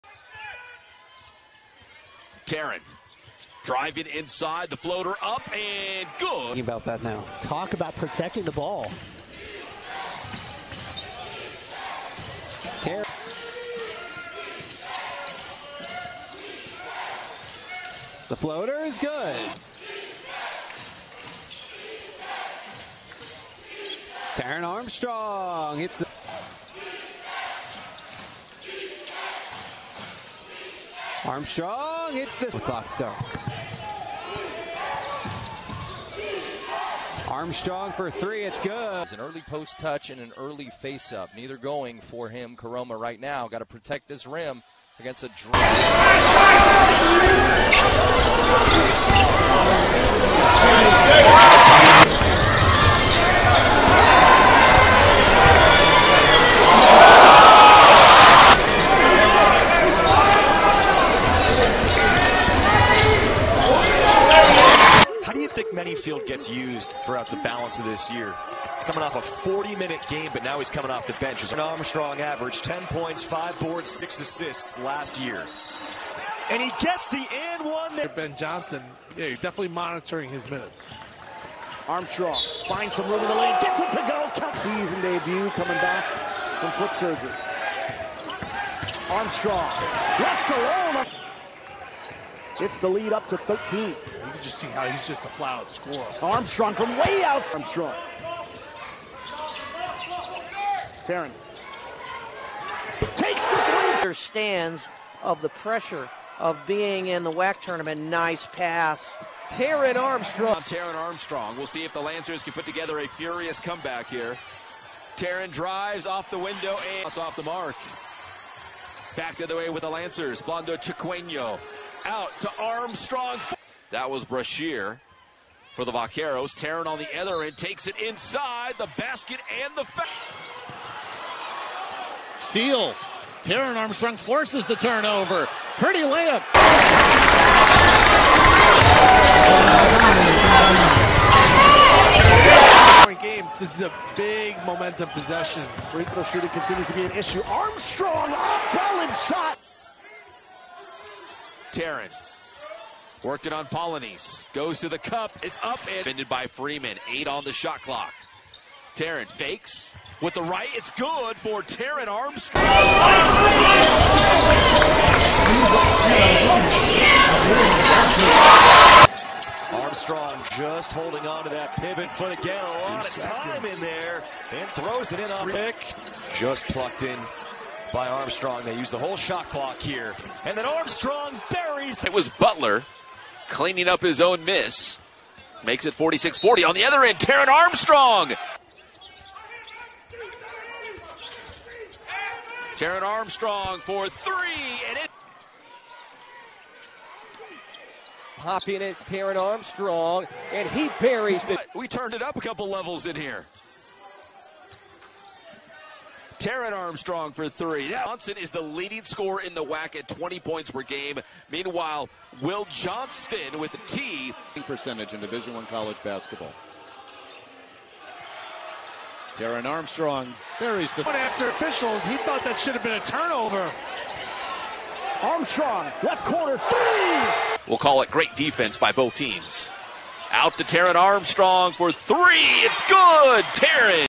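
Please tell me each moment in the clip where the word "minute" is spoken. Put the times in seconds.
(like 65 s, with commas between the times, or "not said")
69 s, 80 s.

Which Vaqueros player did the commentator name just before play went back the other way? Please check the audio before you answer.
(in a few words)
Brashear.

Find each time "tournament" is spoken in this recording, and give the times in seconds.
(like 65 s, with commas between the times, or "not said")
107 s.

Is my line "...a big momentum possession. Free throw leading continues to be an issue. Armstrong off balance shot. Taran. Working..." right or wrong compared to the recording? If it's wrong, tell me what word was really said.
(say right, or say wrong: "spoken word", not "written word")
wrong: "shooting", not "leading".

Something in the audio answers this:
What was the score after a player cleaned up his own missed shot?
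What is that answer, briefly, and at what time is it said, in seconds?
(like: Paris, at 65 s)
46-40, at 185 s.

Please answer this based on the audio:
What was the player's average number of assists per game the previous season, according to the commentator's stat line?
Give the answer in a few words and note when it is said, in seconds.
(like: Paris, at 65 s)
6, at 73 s.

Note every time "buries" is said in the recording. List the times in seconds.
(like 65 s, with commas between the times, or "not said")
181 s, 200 s, 220 s.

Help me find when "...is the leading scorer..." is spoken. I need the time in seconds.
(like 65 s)
208 s.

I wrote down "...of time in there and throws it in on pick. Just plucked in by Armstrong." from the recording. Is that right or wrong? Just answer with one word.
right.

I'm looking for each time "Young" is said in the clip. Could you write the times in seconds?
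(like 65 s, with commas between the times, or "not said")
32 s.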